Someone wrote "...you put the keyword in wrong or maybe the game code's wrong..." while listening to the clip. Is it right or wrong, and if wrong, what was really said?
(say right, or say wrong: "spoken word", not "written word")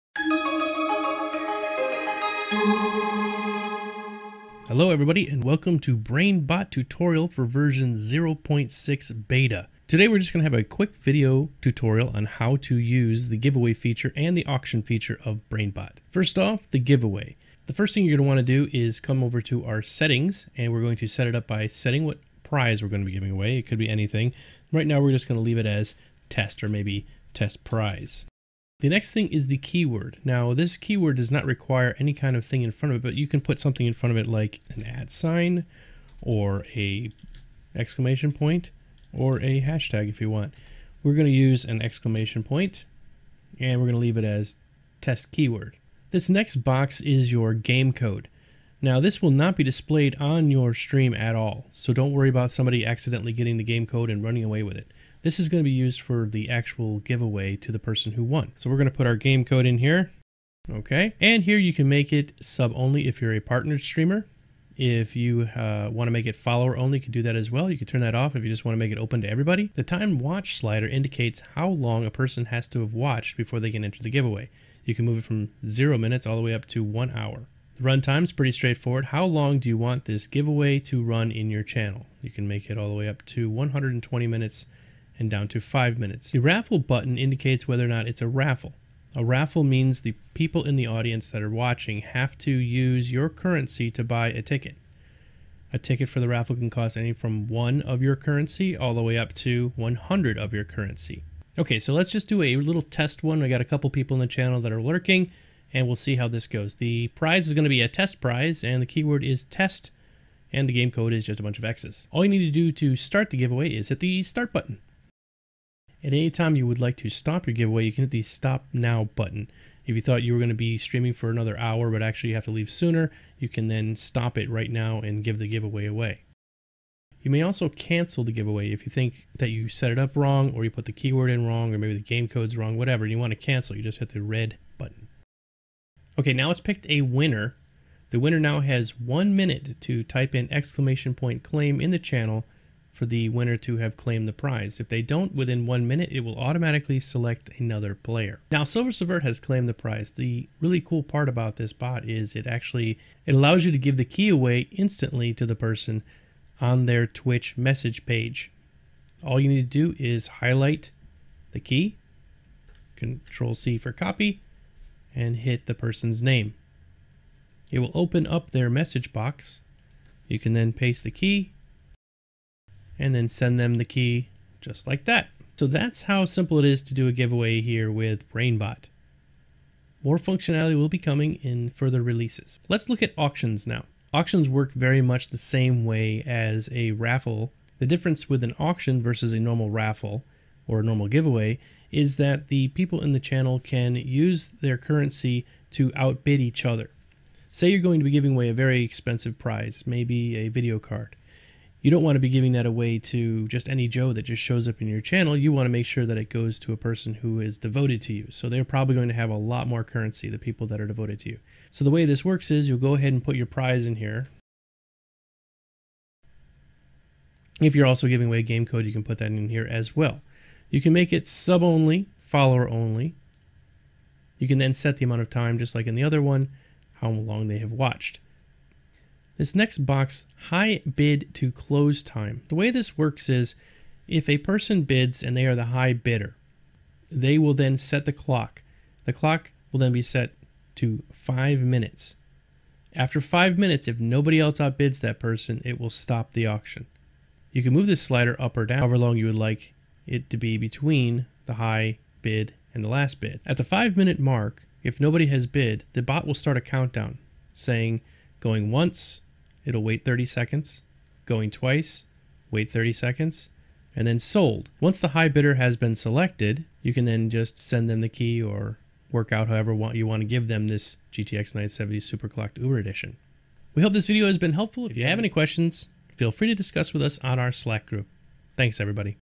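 right.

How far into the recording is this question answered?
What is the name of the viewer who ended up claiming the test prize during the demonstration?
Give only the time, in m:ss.
2:28.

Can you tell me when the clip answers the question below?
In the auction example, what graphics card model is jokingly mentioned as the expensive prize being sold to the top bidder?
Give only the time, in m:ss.
4:31.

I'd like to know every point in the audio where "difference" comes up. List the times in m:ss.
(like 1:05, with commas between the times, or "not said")
3:07.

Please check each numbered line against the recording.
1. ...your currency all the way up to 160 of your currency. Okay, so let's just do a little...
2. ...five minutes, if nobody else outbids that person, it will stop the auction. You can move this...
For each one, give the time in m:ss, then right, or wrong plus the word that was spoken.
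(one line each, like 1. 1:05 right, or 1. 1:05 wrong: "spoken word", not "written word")
1. 1:38 wrong: "100", not "160"
2. 4:03 right.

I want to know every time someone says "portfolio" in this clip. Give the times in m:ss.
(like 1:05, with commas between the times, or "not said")
not said.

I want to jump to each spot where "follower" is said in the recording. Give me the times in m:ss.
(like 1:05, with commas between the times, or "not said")
1:06, 3:42.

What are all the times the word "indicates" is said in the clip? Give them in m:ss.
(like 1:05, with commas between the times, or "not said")
1:10, 1:27.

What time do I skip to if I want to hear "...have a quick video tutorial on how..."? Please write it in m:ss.
0:10.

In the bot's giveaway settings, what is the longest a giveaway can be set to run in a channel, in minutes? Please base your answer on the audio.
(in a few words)
120.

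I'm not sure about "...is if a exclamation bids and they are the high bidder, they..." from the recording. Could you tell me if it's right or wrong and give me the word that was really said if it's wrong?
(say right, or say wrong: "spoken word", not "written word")
wrong: "person", not "exclamation".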